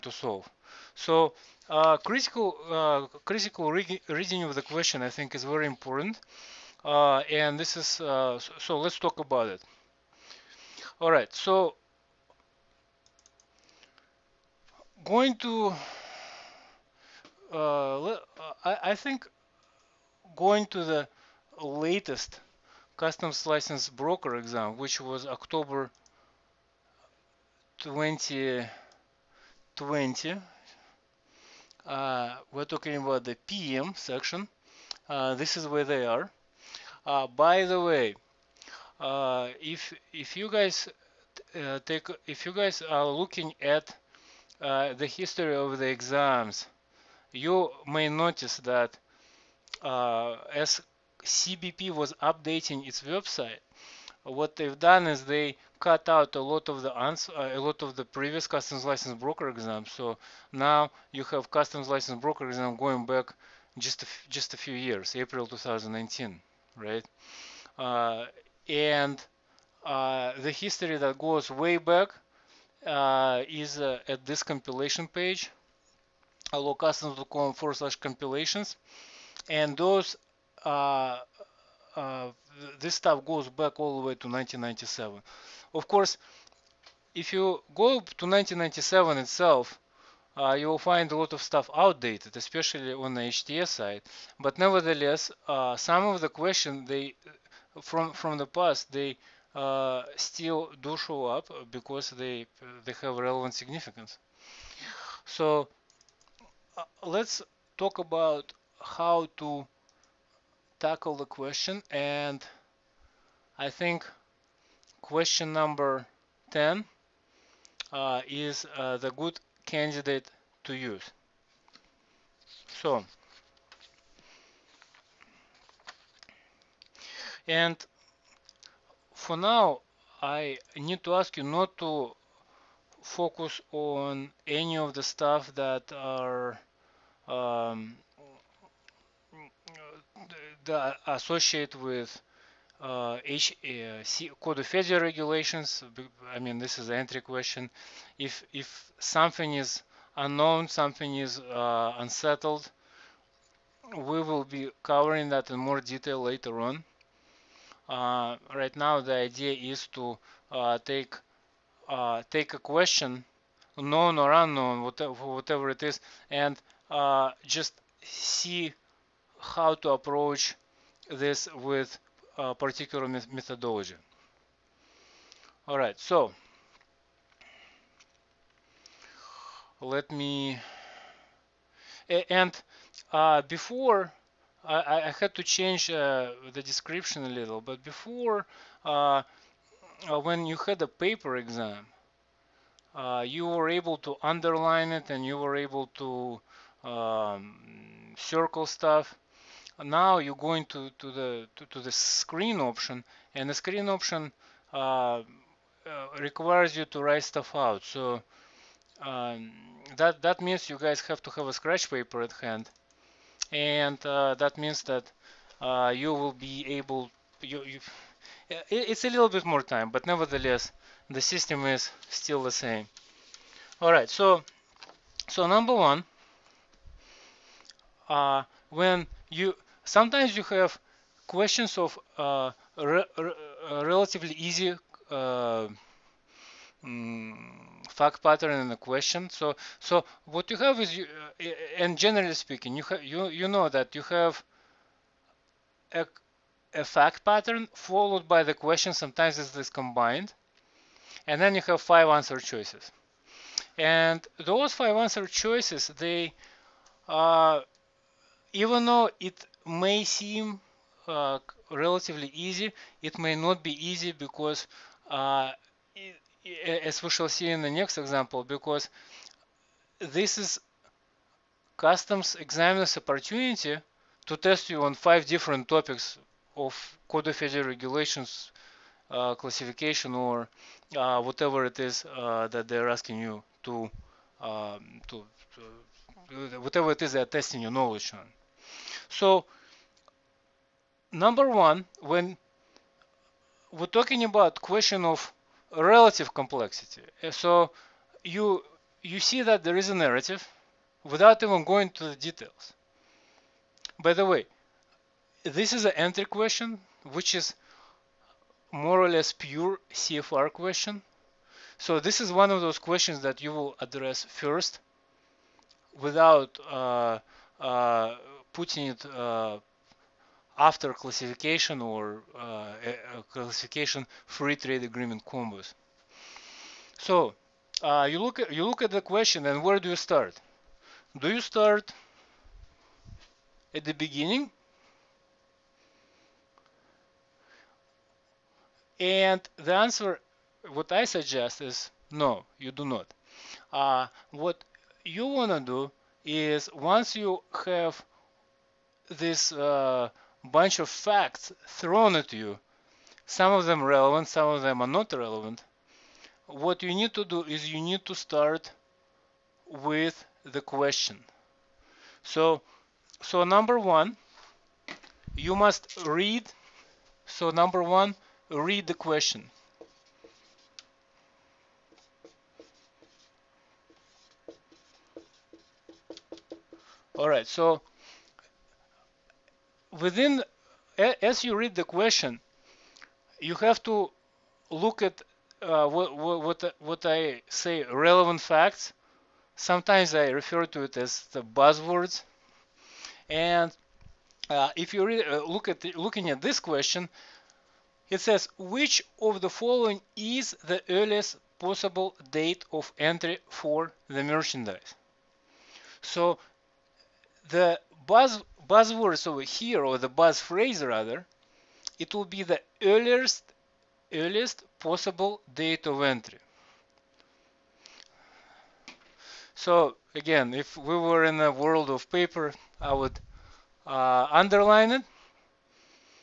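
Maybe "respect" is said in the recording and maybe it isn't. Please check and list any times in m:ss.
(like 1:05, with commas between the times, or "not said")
not said.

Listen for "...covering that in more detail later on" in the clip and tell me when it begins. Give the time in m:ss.
2:34.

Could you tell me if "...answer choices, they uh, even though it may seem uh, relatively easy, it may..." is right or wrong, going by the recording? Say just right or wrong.
right.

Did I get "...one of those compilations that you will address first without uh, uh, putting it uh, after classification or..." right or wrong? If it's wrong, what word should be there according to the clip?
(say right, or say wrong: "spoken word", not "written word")
wrong: "questions", not "compilations".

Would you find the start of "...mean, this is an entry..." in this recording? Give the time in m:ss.
2:26.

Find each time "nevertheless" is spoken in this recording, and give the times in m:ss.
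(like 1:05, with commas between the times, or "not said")
1:34, 3:40.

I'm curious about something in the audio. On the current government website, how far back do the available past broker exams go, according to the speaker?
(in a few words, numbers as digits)
April 2019.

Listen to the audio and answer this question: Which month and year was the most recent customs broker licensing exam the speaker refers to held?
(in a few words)
October 2020.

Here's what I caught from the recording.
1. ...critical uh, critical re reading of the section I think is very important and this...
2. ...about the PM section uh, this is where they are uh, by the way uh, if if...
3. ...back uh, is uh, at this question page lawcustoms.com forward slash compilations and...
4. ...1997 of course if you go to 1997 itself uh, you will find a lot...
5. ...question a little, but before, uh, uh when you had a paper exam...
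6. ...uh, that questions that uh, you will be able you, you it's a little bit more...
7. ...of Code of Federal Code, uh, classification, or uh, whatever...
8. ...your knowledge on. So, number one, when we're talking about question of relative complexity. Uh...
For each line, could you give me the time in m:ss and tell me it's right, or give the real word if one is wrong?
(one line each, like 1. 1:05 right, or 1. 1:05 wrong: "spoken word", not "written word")
1. 0:01 wrong: "question", not "section"
2. 0:32 right
3. 1:11 wrong: "compilation", not "question"
4. 1:24 right
5. 3:06 wrong: "description", not "question"
6. 3:34 wrong: "means", not "questions"
7. 4:36 wrong: "Regulations", not "Code"
8. 4:47 right.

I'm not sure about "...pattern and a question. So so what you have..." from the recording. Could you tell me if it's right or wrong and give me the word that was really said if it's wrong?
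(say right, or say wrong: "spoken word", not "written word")
right.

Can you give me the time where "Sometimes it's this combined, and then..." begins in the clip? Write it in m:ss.
4:08.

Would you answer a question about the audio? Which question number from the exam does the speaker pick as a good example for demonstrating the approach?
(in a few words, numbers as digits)
10.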